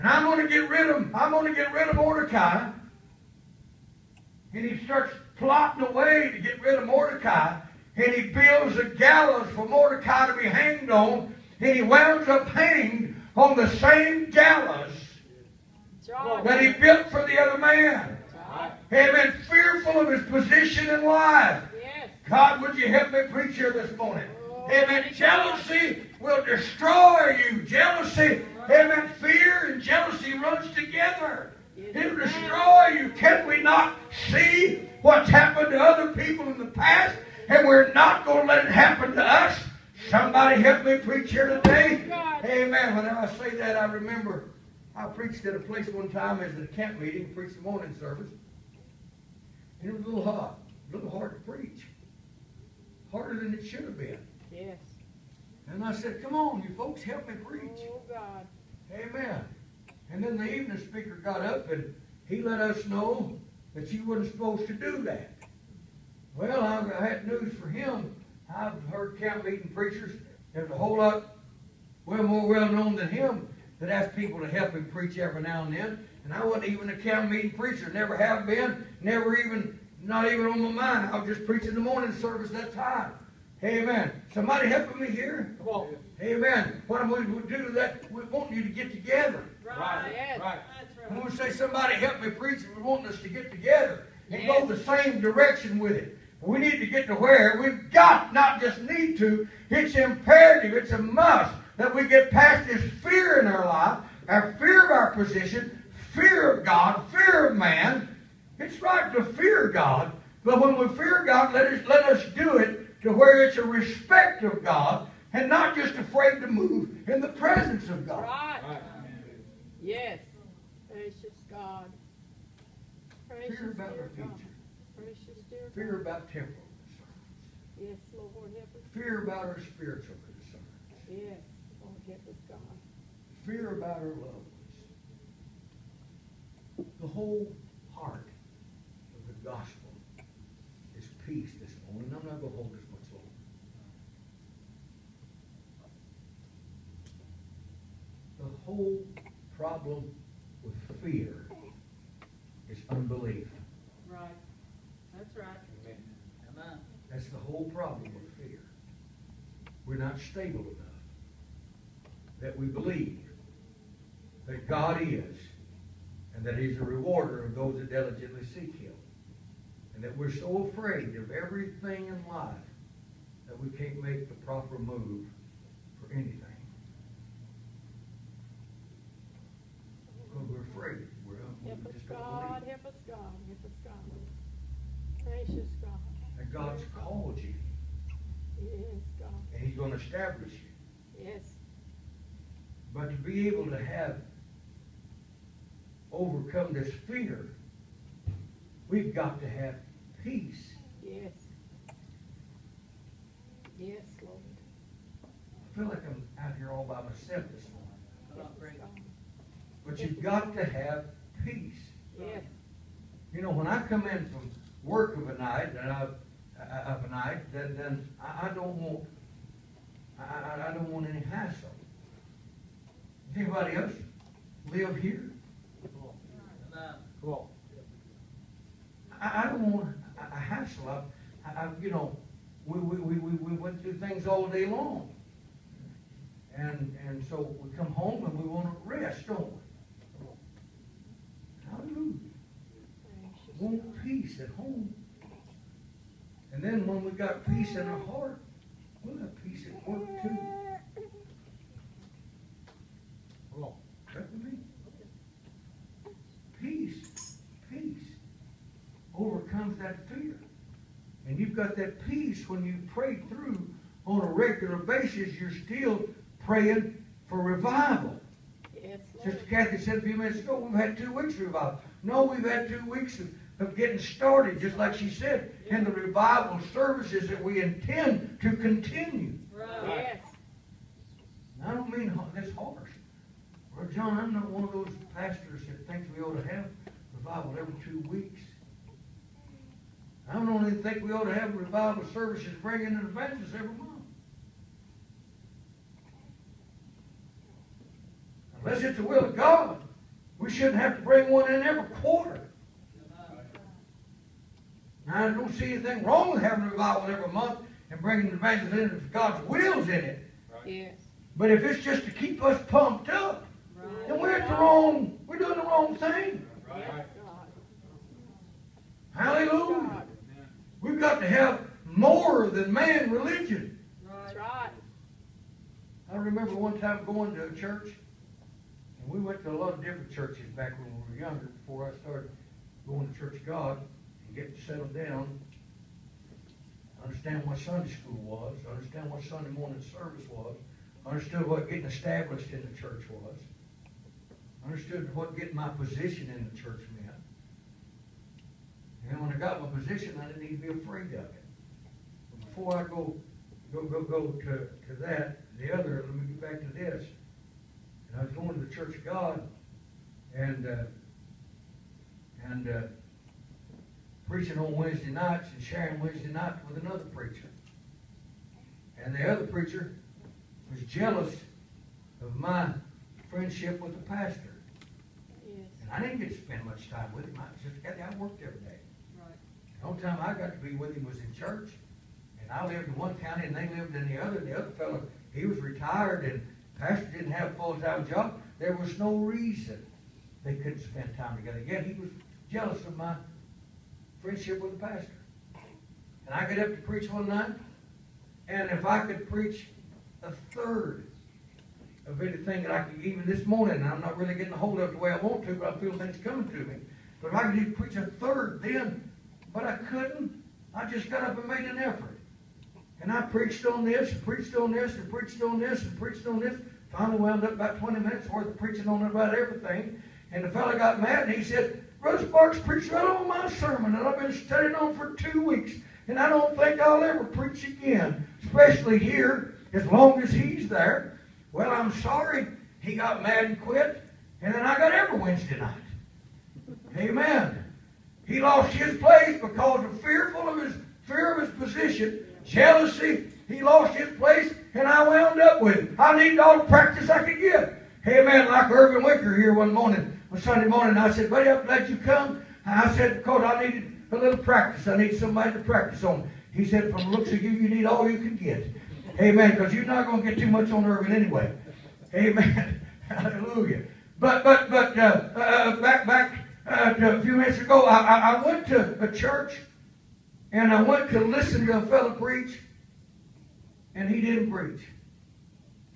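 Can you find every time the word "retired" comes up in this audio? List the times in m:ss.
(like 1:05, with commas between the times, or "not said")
6:25.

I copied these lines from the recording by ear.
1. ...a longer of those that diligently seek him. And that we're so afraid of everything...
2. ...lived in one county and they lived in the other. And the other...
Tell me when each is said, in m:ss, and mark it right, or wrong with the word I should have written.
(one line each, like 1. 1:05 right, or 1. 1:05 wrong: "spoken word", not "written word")
1. 2:46 wrong: "rewarder", not "longer"
2. 6:22 right.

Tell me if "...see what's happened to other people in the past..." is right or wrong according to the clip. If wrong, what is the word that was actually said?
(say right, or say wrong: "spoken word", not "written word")
right.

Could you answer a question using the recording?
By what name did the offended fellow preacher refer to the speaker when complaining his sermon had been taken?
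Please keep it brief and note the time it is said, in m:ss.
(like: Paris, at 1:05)
Brother Sparks, at 7:02.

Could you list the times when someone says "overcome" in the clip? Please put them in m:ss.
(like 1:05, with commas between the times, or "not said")
3:16, 4:19.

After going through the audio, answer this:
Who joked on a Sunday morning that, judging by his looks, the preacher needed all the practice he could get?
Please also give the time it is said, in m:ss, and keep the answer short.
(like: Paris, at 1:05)
Irvin Wicker, at 7:28.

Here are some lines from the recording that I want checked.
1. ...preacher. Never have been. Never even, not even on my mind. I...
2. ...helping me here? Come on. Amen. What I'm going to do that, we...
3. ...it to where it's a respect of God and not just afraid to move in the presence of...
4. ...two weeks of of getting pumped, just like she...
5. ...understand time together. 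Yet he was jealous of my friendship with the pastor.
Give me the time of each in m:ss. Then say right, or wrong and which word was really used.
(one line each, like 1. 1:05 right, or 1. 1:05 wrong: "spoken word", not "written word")
1. 1:17 right
2. 1:24 right
3. 1:52 right
4. 4:32 wrong: "started", not "pumped"
5. 6:30 wrong: "spend", not "understand".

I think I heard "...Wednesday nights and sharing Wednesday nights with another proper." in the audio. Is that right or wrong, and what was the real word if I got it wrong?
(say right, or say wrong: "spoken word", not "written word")
wrong: "preacher", not "proper".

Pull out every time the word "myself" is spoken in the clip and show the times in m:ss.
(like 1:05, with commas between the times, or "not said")
3:27.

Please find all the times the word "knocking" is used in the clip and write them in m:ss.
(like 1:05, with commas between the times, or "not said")
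not said.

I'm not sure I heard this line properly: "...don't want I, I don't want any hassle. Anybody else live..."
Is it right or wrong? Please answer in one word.
right.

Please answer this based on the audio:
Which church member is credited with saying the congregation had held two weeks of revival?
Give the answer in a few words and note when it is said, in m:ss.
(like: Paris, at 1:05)
Sister Kathy, at 4:29.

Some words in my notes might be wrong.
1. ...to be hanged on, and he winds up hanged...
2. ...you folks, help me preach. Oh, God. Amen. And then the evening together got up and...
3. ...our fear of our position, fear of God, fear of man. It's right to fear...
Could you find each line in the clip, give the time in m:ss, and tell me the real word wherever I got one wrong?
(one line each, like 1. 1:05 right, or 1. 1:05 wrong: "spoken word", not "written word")
1. 0:10 right
2. 0:56 wrong: "speaker", not "together"
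3. 1:44 right.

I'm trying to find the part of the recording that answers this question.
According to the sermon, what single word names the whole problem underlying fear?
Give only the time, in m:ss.
2:32.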